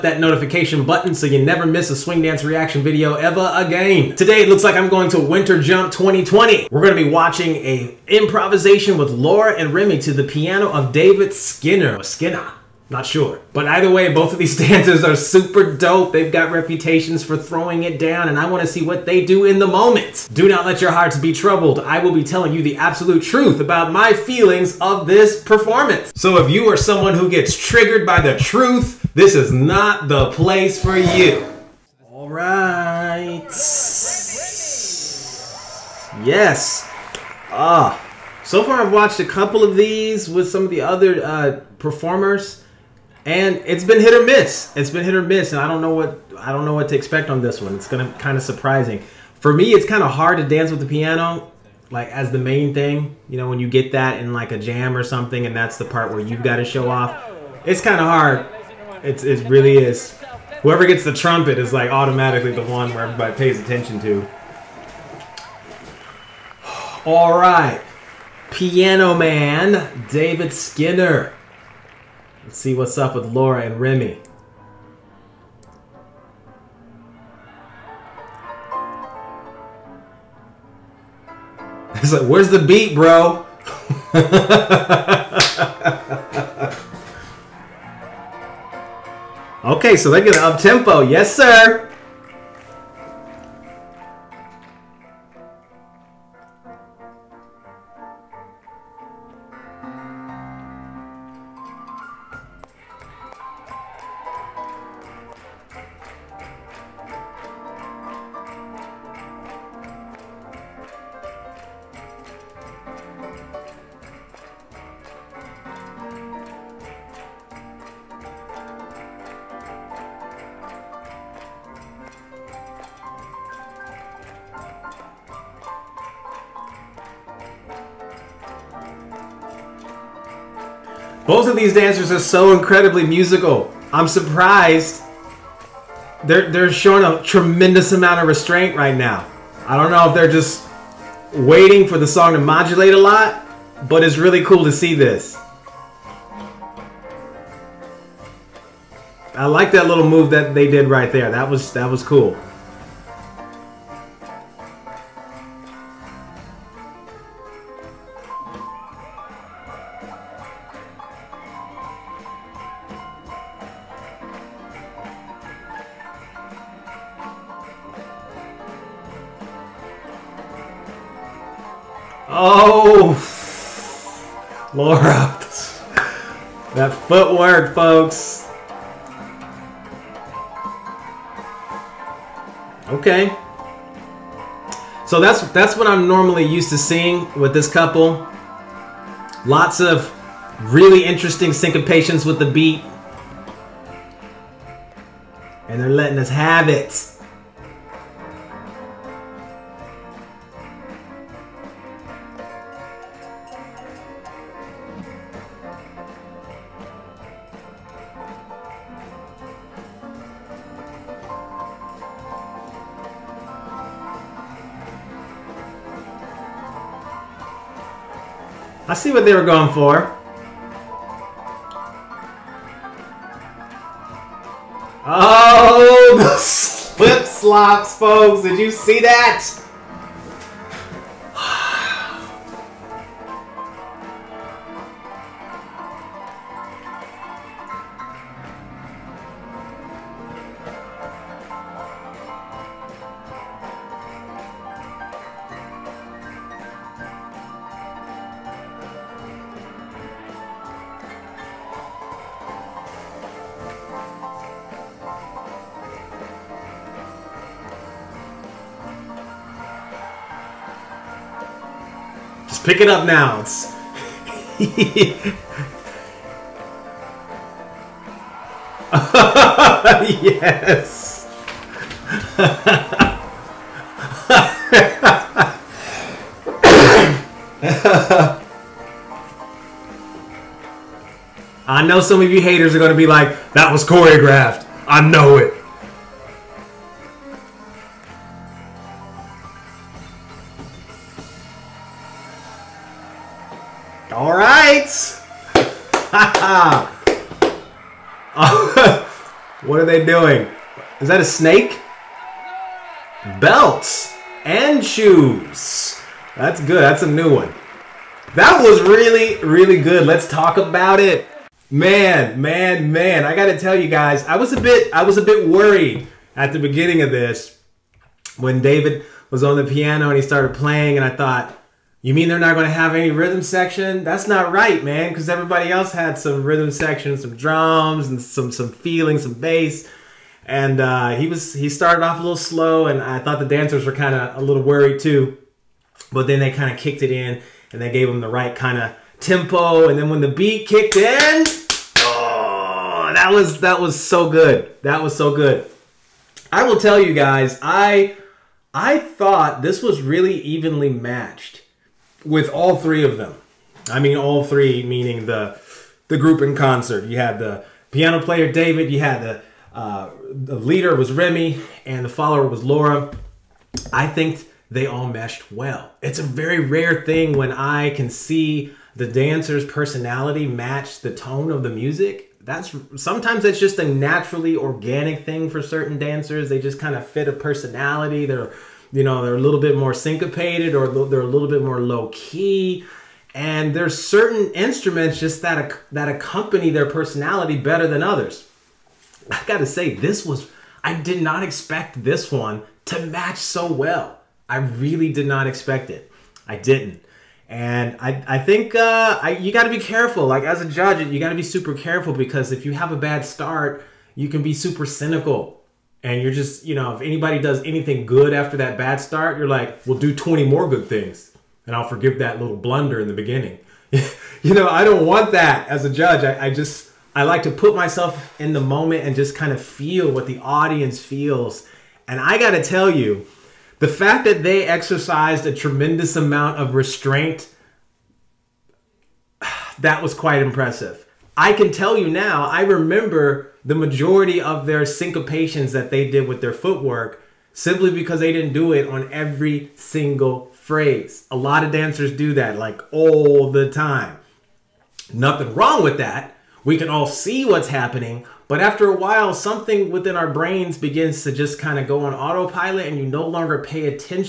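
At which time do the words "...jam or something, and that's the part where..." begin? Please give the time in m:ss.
0:54.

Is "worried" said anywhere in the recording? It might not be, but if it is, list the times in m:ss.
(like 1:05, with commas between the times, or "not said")
5:15, 5:34.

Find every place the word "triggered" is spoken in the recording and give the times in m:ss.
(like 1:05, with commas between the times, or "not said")
0:27.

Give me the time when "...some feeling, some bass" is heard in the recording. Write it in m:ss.
5:28.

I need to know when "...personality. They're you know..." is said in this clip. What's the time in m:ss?
6:17.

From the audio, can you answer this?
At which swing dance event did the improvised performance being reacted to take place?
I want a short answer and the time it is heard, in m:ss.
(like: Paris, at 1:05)
Winter Jump 2020, at 0:05.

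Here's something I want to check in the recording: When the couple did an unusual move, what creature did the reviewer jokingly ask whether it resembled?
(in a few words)
A snake.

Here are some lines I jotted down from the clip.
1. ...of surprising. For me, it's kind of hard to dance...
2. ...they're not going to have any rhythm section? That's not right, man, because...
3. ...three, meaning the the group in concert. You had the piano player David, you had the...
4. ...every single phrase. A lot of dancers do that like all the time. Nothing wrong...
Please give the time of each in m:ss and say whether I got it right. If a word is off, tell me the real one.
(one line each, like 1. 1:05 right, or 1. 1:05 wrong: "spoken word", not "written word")
1. 0:48 right
2. 5:22 right
3. 5:54 right
4. 7:19 right.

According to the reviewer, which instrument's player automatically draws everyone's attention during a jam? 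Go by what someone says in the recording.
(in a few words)
Trumpet.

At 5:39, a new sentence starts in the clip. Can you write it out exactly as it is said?
And then when the beat kicked in, oh, that was that was so good.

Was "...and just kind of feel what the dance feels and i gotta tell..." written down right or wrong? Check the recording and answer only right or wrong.
wrong.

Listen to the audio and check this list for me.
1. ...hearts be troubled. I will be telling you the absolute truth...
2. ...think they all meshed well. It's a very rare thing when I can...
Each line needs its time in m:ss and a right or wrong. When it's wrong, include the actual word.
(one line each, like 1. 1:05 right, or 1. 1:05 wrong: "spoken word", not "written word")
1. 0:20 right
2. 6:04 right.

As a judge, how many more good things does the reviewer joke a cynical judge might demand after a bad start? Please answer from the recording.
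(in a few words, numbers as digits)
20.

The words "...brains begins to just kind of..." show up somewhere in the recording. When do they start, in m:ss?
7:30.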